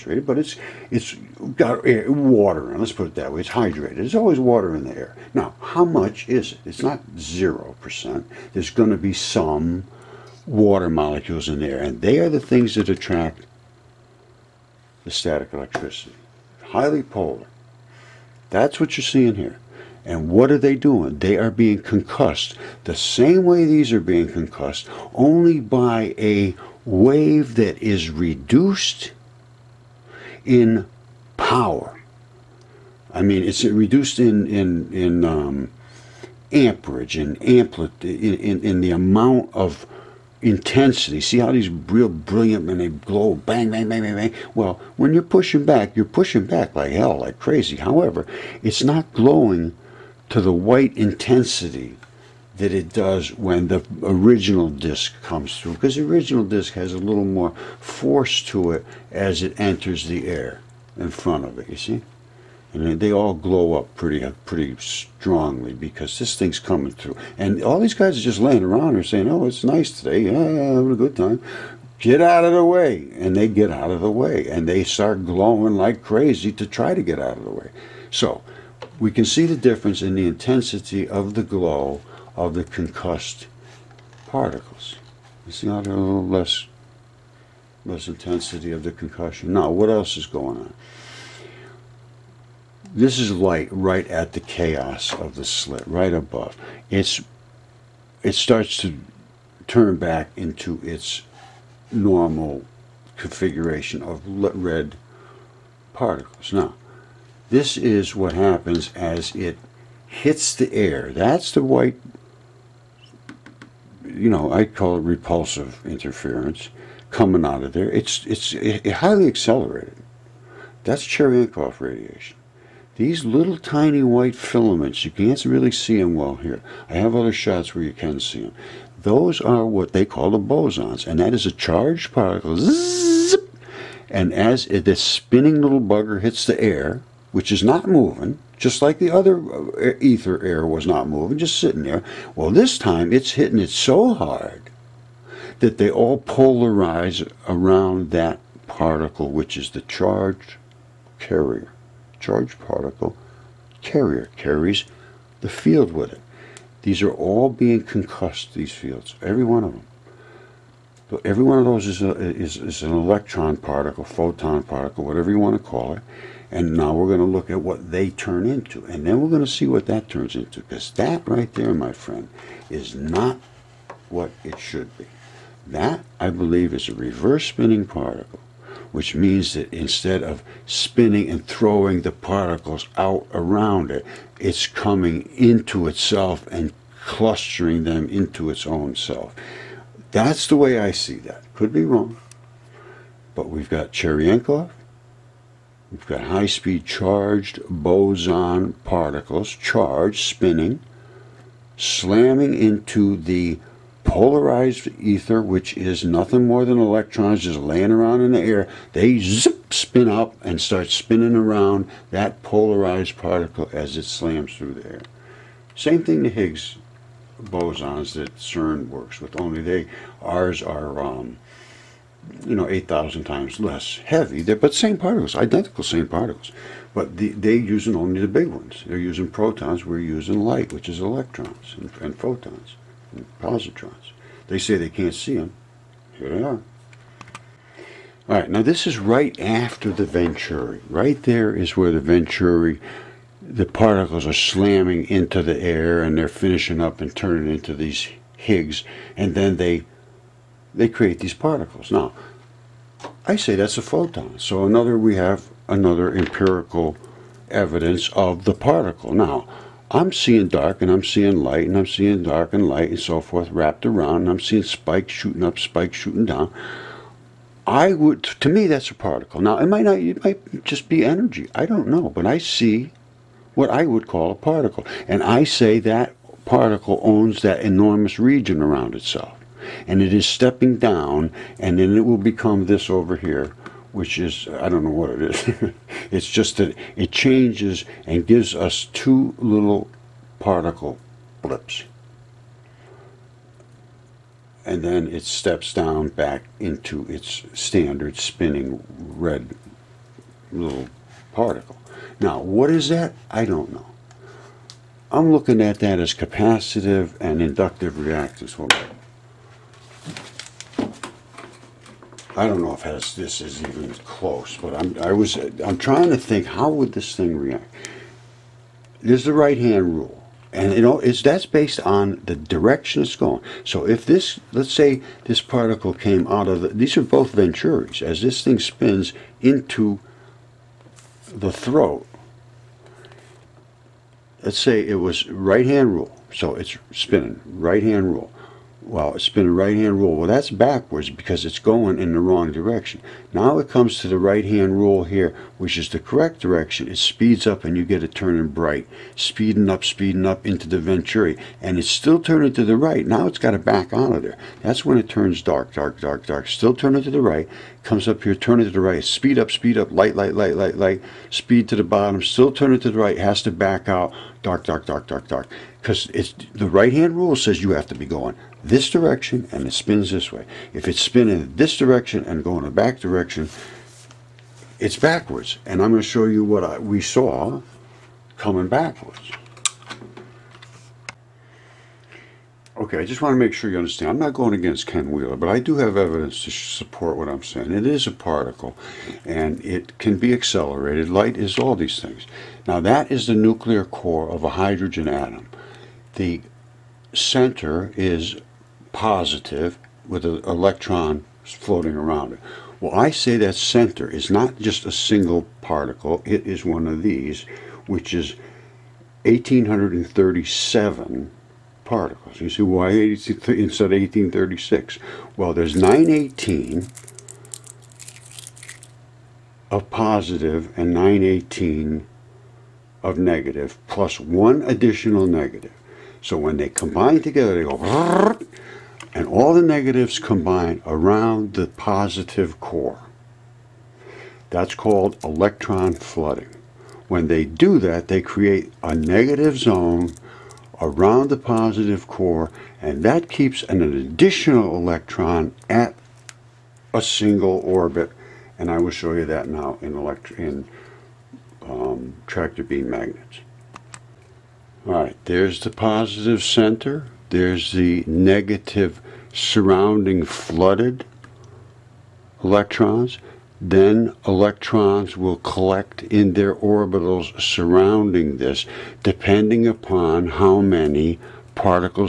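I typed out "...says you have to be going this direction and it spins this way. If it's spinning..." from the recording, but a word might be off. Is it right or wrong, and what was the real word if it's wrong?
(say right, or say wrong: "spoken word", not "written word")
right.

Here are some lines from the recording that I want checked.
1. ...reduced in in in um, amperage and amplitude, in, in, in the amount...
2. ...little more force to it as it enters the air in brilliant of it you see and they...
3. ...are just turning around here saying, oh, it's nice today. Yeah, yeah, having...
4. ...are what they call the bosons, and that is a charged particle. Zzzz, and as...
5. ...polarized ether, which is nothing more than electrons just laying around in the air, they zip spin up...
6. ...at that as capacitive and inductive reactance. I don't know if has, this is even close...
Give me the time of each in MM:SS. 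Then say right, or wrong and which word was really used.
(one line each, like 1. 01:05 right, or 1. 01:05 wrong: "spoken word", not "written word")
1. 00:33 right
2. 00:56 wrong: "front", not "brilliant"
3. 01:08 wrong: "laying", not "turning"
4. 02:09 right
5. 03:24 right
6. 05:05 right.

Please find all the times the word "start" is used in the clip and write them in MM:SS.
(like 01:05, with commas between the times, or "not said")
01:14, 01:38, 03:30.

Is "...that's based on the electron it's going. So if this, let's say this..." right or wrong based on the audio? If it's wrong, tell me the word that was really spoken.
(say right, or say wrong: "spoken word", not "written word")
wrong: "direction", not "electron".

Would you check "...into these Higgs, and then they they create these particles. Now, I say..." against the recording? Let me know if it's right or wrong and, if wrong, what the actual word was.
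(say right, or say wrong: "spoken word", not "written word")
right.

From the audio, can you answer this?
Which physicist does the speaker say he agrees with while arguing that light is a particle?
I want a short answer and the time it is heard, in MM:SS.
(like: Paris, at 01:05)
Ken Wheeler, at 06:24.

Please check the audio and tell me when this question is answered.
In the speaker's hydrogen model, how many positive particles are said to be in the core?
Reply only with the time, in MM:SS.
06:55.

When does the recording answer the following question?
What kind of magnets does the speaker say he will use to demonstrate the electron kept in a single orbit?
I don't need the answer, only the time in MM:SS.
07:32.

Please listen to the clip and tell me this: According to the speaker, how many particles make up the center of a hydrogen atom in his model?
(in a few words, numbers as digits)
1837.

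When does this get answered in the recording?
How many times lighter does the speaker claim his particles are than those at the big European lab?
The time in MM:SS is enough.
03:42.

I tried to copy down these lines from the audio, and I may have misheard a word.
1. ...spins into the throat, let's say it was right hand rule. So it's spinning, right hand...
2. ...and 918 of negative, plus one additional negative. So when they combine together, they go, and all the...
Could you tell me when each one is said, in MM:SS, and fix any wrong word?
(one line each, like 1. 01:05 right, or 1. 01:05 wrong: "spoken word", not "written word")
1. 05:28 right
2. 07:00 right.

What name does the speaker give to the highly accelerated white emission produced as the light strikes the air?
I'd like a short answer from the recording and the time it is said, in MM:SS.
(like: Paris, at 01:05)
Cherenkov radiation, at 02:01.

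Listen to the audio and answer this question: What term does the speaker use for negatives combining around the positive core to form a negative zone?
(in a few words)
electron flooding.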